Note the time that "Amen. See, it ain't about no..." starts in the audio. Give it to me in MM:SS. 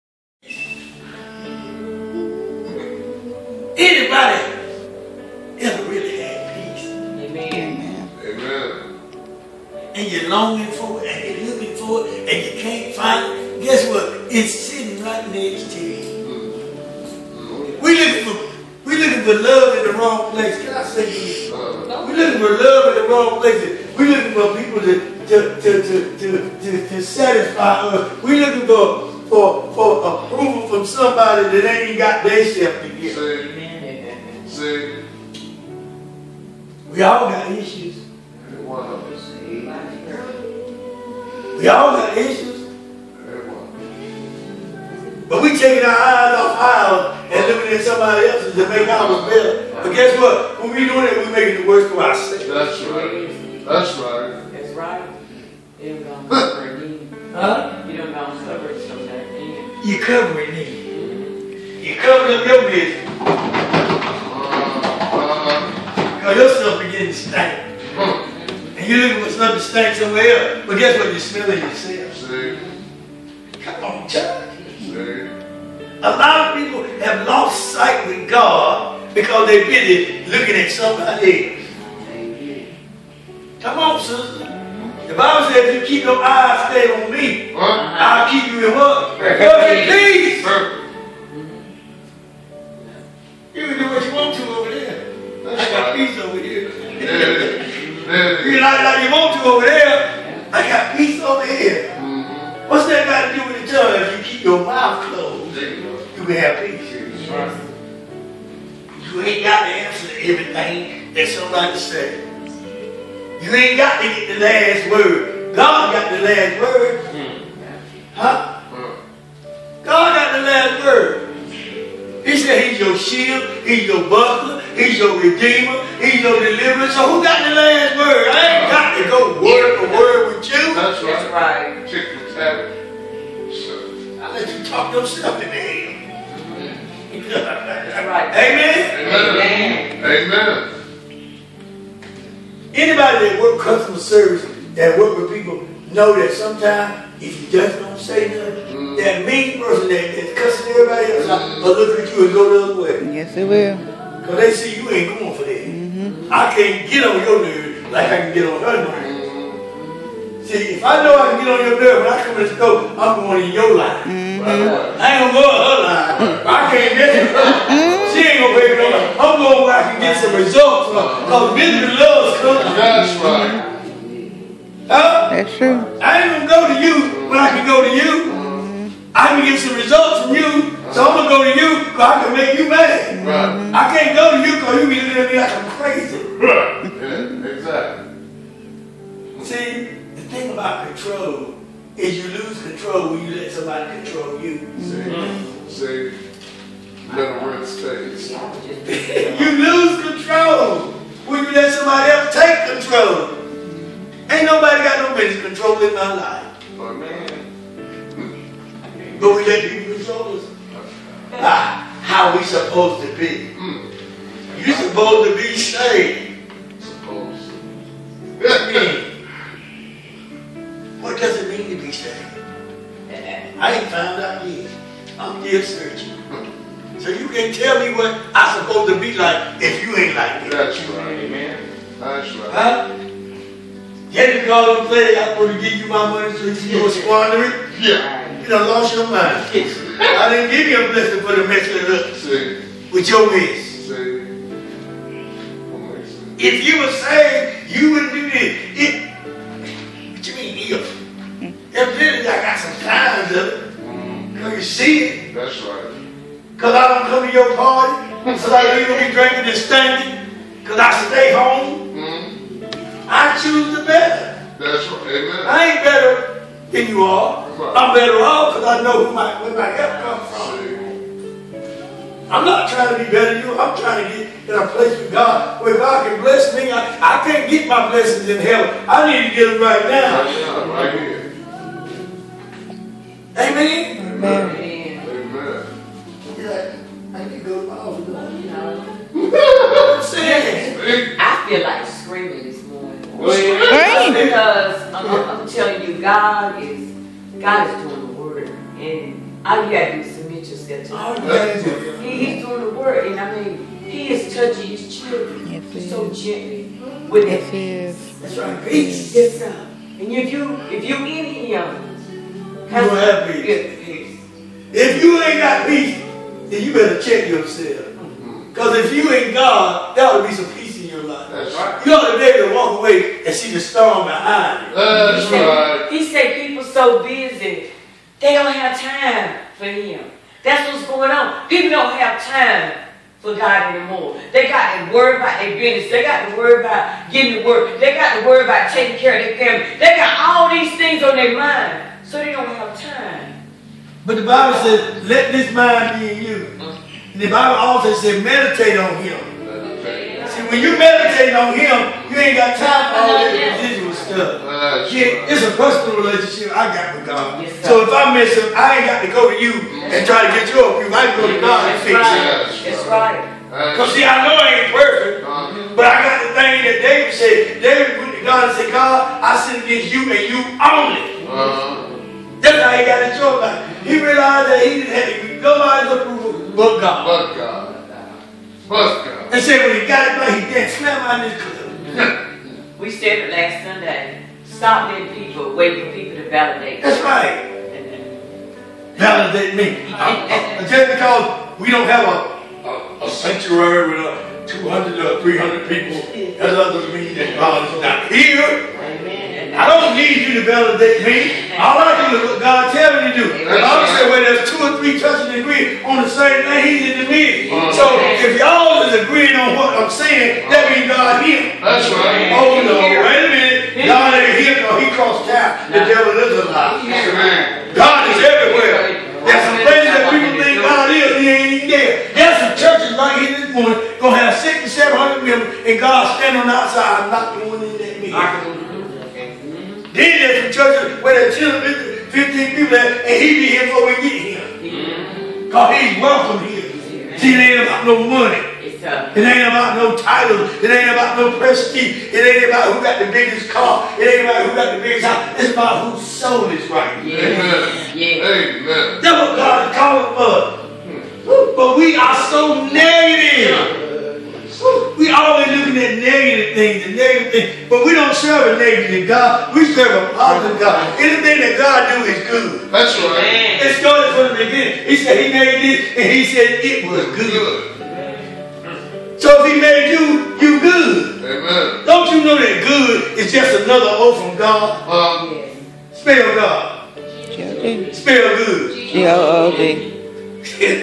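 07:16.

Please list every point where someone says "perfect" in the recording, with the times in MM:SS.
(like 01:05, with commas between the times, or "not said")
01:29, 06:04.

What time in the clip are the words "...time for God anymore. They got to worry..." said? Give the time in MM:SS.
05:32.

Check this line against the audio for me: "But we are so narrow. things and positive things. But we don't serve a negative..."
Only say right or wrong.
wrong.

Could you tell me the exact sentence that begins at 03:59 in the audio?
I didn't give you a blessing for the mess with us.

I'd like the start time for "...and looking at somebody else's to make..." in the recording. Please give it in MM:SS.
00:47.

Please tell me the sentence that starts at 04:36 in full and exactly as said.
I, I can't get my blessings in heaven.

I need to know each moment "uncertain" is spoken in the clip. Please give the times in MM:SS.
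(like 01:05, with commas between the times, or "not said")
not said.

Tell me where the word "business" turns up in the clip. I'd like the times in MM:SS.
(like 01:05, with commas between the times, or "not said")
01:02, 02:51, 03:25, 05:35.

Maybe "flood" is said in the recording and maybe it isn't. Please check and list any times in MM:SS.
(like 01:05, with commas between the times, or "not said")
not said.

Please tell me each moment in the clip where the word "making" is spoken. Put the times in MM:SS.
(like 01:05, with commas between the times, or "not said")
00:51.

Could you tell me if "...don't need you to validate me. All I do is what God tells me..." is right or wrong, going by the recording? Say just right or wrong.
right.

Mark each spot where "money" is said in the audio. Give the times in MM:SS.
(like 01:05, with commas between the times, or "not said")
03:56, 07:18.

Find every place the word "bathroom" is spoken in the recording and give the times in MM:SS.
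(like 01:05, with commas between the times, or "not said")
not said.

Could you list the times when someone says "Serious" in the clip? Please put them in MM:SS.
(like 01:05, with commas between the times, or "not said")
04:50.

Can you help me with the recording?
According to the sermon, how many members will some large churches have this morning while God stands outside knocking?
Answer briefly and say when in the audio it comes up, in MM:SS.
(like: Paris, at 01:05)
600 to 700, at 07:04.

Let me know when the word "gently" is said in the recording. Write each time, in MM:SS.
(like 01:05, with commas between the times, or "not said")
05:06.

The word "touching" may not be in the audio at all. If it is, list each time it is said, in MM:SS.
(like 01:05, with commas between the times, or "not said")
05:04, 06:44.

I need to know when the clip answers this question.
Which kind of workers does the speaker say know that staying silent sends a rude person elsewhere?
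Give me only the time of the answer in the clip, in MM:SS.
02:23.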